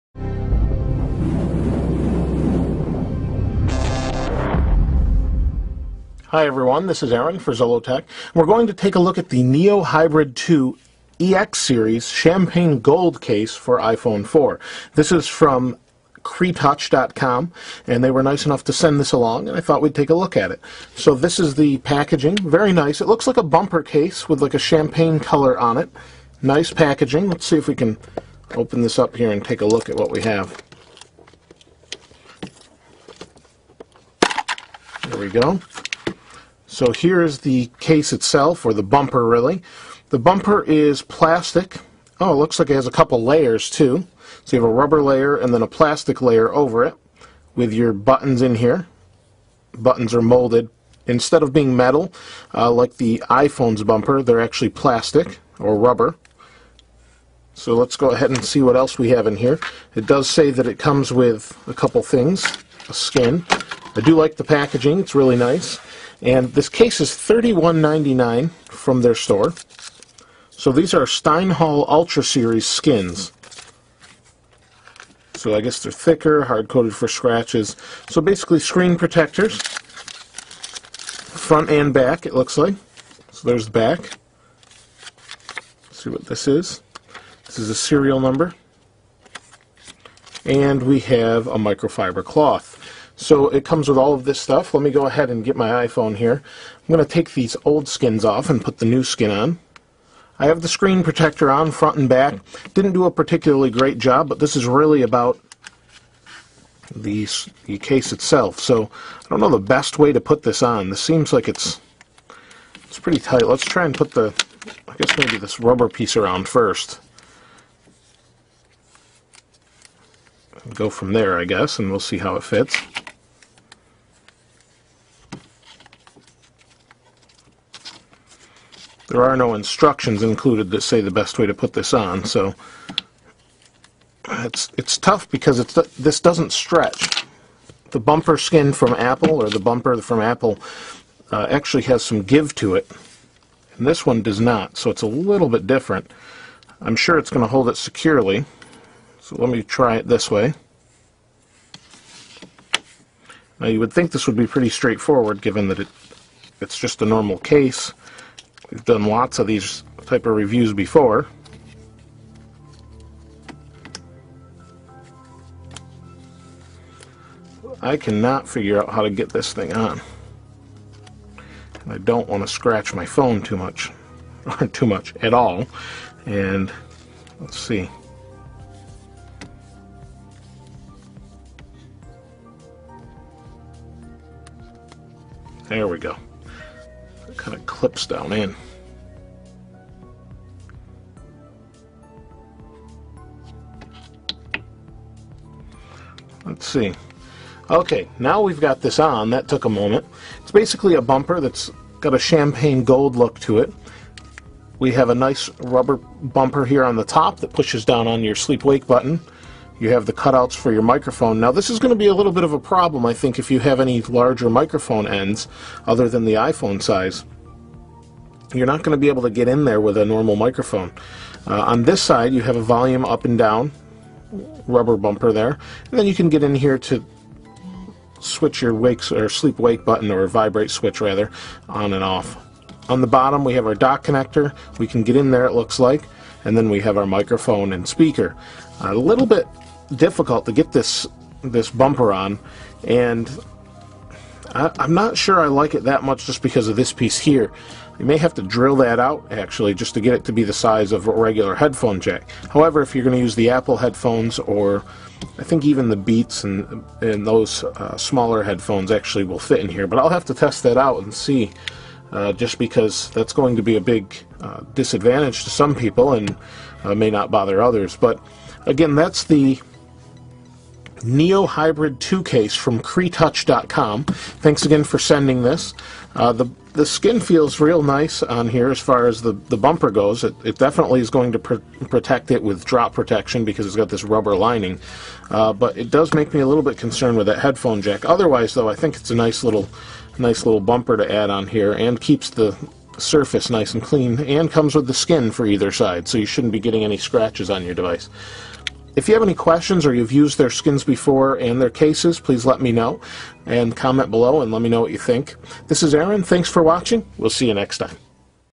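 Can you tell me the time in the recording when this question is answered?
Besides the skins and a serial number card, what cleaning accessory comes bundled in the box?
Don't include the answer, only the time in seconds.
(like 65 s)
91 s.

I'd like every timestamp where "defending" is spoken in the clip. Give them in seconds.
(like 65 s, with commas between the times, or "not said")
not said.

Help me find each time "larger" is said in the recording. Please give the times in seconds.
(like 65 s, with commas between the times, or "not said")
214 s.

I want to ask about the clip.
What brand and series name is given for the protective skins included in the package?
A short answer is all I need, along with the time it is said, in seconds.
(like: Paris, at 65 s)
Steinheil Ultra Series, at 71 s.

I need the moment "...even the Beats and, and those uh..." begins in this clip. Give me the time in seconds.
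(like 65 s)
255 s.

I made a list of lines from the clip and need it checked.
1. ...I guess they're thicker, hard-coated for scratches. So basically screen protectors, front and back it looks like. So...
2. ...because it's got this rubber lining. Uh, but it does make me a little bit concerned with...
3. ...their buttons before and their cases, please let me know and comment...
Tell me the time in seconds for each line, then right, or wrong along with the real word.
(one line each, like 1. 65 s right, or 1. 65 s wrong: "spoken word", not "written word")
1. 75 s right
2. 283 s right
3. 300 s wrong: "skins", not "buttons".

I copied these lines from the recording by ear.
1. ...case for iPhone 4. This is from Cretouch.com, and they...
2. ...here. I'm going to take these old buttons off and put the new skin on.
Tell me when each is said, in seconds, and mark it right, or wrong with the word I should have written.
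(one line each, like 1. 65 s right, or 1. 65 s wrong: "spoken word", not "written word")
1. 13 s right
2. 96 s wrong: "skins", not "buttons".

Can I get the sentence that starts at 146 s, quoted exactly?
I'm sure it's going to hold it securely, so let me try it this way.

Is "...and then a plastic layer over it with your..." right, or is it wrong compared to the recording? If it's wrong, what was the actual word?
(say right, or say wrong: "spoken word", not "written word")
right.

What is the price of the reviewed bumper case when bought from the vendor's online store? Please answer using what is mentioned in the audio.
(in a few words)
$31.99.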